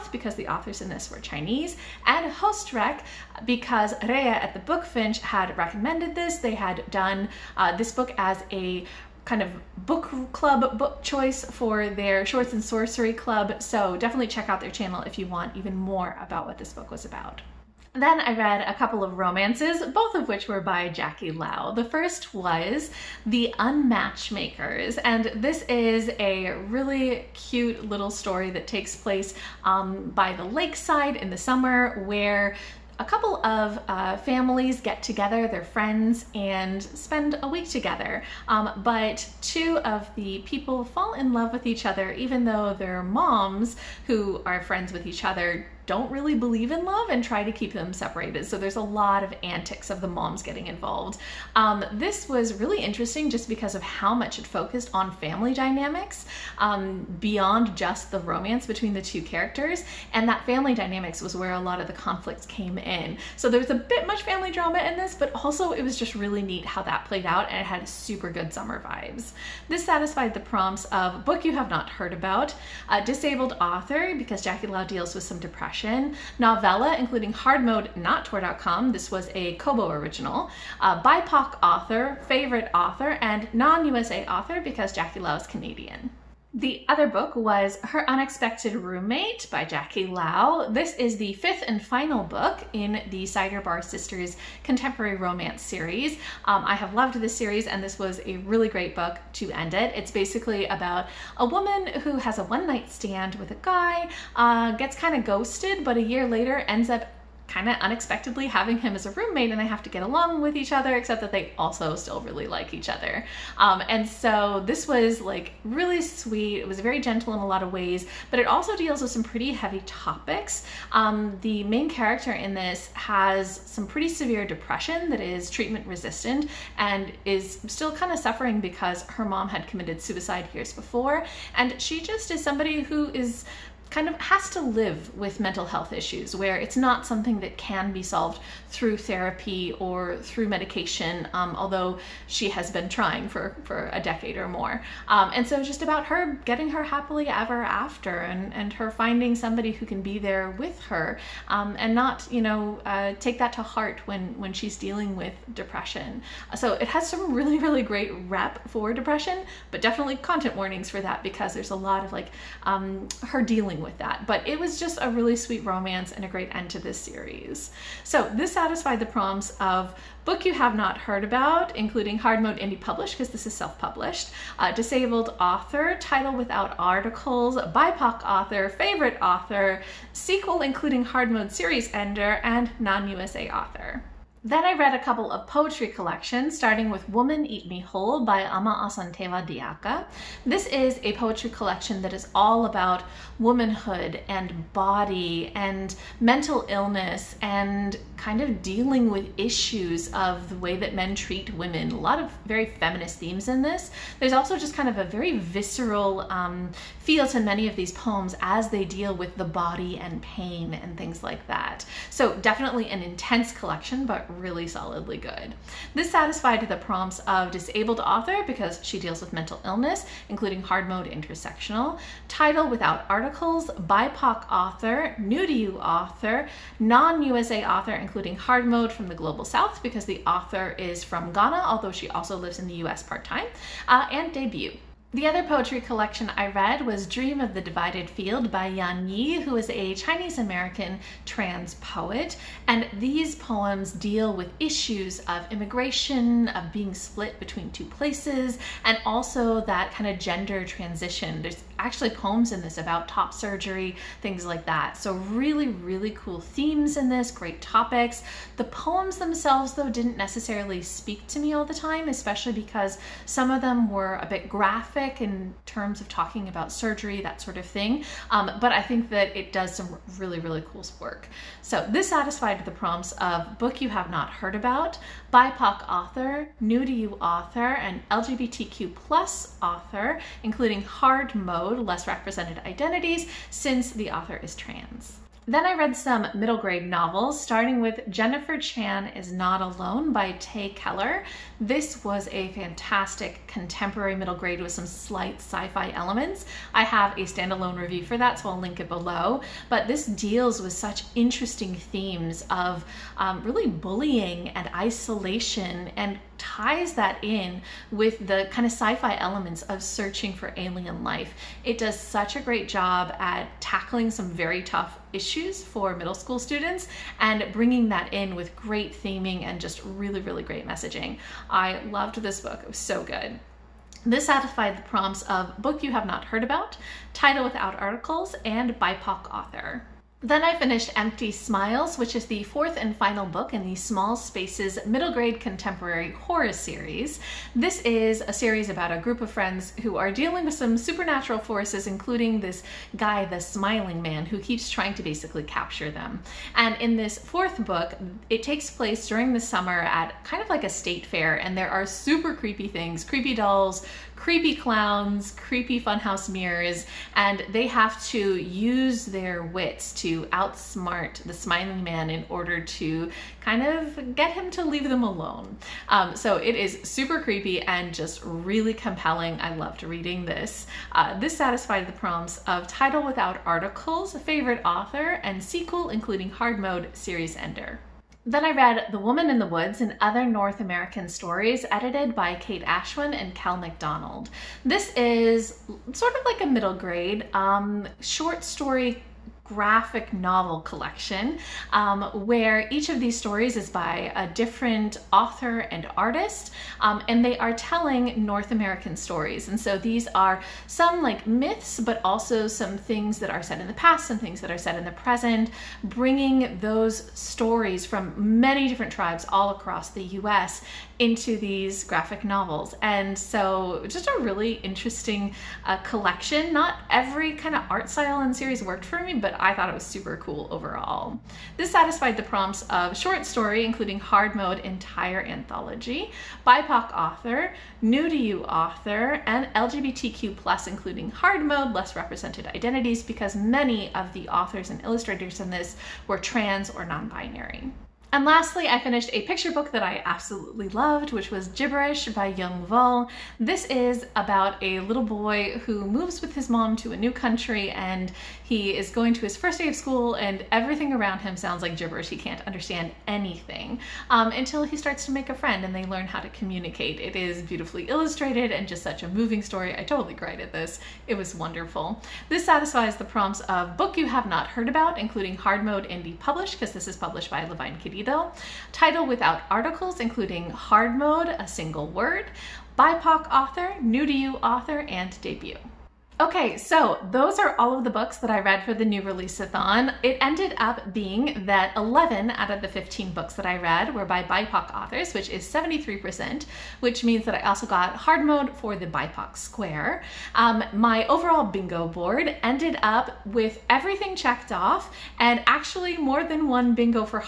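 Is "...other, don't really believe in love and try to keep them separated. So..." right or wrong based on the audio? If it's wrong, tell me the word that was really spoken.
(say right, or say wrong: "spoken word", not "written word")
right.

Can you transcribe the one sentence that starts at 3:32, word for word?
So definitely an intense collection, but really solidly good.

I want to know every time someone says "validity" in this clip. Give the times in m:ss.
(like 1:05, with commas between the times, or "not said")
not said.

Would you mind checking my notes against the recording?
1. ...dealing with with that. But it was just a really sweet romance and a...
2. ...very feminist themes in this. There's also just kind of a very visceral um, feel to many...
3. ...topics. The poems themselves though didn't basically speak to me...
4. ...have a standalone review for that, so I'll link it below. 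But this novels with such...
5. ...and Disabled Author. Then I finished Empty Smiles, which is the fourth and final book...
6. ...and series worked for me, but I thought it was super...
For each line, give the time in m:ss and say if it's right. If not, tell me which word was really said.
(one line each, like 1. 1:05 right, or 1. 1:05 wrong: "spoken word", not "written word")
1. 2:43 right
2. 3:22 right
3. 4:17 wrong: "necessarily", not "basically"
4. 4:56 wrong: "deals", not "novels"
5. 5:28 wrong: "BIPOC", not "Disabled"
6. 6:58 right.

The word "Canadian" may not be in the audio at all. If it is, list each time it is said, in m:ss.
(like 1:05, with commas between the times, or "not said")
1:25.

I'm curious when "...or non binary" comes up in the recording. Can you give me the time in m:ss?
7:16.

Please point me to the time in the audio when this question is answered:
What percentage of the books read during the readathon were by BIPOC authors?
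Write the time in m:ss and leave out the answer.
8:05.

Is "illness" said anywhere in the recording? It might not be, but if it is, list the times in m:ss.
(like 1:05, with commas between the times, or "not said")
3:16, 3:39.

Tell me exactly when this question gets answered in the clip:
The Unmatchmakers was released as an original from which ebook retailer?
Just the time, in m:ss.
1:19.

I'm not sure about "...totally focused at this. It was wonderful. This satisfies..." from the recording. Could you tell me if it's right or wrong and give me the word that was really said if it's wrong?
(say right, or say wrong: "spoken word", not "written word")
wrong: "cried", not "focused".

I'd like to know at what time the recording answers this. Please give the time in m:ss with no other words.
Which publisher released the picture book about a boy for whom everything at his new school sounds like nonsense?
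7:47.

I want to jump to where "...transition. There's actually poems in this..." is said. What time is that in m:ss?
4:10.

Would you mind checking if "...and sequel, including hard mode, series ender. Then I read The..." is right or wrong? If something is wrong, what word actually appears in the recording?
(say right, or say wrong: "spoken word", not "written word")
right.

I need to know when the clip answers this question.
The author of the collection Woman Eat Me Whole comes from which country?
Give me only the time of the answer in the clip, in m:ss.
3:51.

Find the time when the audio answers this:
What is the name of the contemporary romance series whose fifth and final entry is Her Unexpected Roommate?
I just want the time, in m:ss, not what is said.
1:33.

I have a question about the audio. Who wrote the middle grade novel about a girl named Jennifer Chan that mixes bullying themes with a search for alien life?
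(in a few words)
Tae Keller.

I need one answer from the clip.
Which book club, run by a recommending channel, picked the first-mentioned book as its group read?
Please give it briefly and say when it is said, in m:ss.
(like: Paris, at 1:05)
Shorts and Sorcery Club, at 0:12.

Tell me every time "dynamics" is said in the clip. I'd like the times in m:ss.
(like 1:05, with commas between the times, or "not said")
0:55, 1:00.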